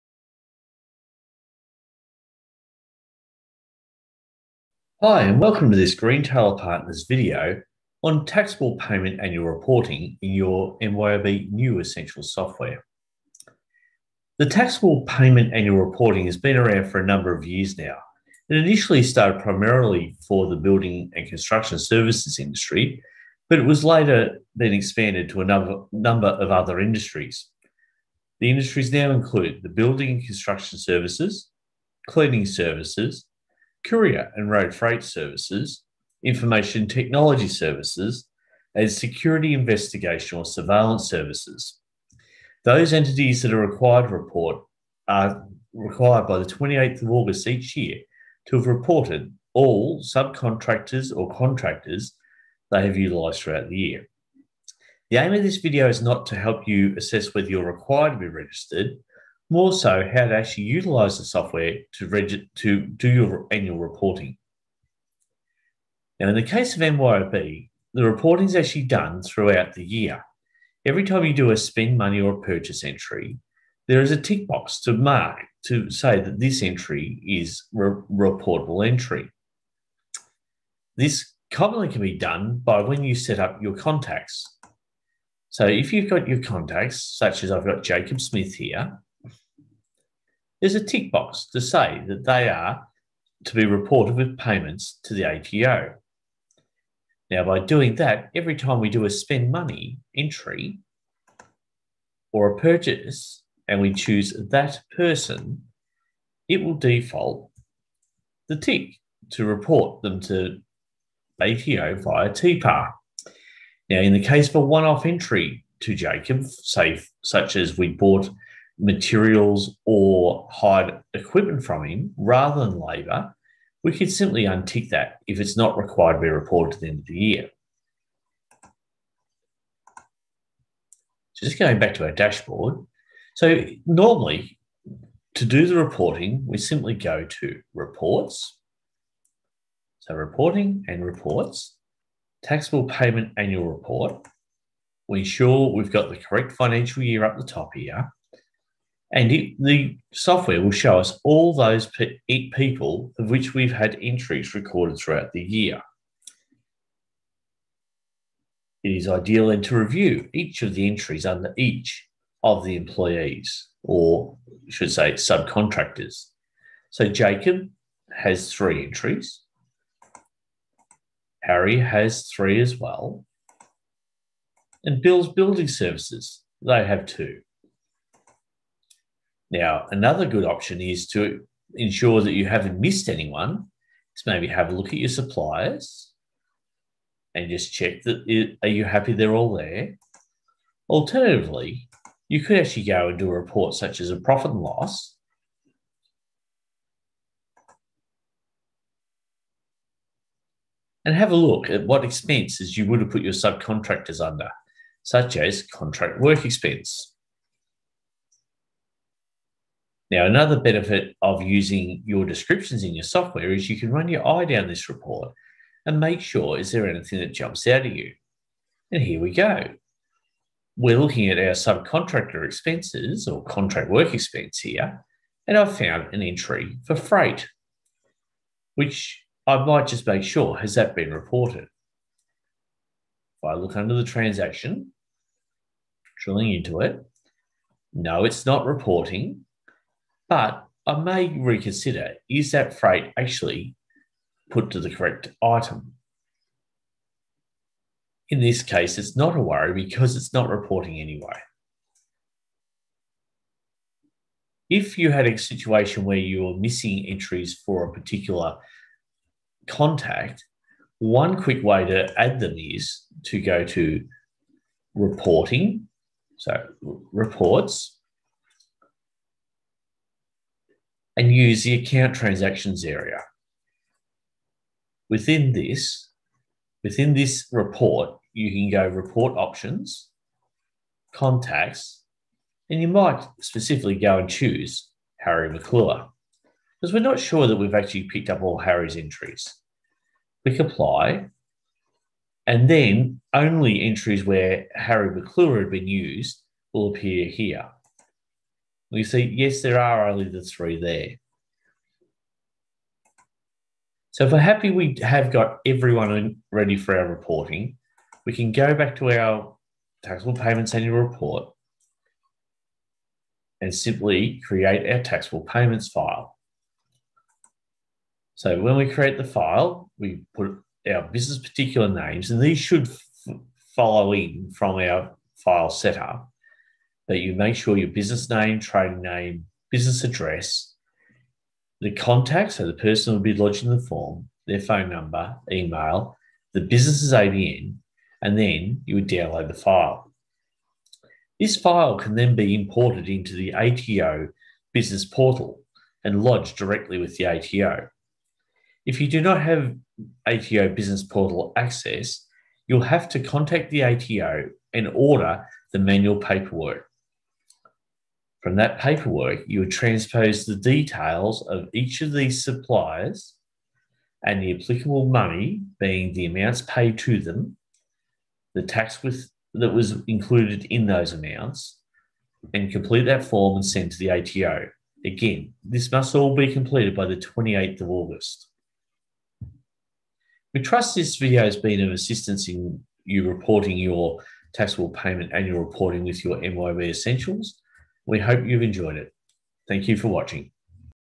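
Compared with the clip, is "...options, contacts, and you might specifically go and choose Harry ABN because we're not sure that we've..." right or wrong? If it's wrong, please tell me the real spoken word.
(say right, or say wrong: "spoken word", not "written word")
wrong: "McClure", not "ABN".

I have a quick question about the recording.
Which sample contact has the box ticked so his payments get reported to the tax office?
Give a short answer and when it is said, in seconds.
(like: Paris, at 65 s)
Jacob Smith, at 87 s.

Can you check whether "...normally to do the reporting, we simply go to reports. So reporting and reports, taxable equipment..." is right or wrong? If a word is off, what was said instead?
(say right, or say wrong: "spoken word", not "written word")
wrong: "payment", not "equipment".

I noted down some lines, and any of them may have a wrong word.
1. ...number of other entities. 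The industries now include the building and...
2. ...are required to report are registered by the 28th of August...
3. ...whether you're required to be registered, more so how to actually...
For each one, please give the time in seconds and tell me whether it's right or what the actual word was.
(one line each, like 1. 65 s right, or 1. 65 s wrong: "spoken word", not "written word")
1. 25 s wrong: "industries", not "entities"
2. 43 s wrong: "required", not "registered"
3. 57 s right.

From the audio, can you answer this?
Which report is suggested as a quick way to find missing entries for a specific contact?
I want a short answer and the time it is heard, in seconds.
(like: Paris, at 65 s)
Account transactions, at 271 s.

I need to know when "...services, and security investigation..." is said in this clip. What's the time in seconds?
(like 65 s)
37 s.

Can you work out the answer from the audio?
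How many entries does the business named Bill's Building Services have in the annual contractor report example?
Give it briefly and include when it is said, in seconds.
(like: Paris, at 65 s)
2, at 177 s.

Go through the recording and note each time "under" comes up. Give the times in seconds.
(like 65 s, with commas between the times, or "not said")
161 s, 204 s, 233 s.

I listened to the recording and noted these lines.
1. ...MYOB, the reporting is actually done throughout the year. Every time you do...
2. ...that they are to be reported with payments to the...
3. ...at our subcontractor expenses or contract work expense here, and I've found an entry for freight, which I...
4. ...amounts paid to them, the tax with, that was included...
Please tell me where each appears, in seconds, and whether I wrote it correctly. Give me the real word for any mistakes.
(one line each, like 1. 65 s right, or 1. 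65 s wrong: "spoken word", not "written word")
1. 66 s right
2. 92 s right
3. 221 s right
4. 366 s right.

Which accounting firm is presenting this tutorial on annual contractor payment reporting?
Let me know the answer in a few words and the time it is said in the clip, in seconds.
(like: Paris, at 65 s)
Green Taylor Partners, at 5 s.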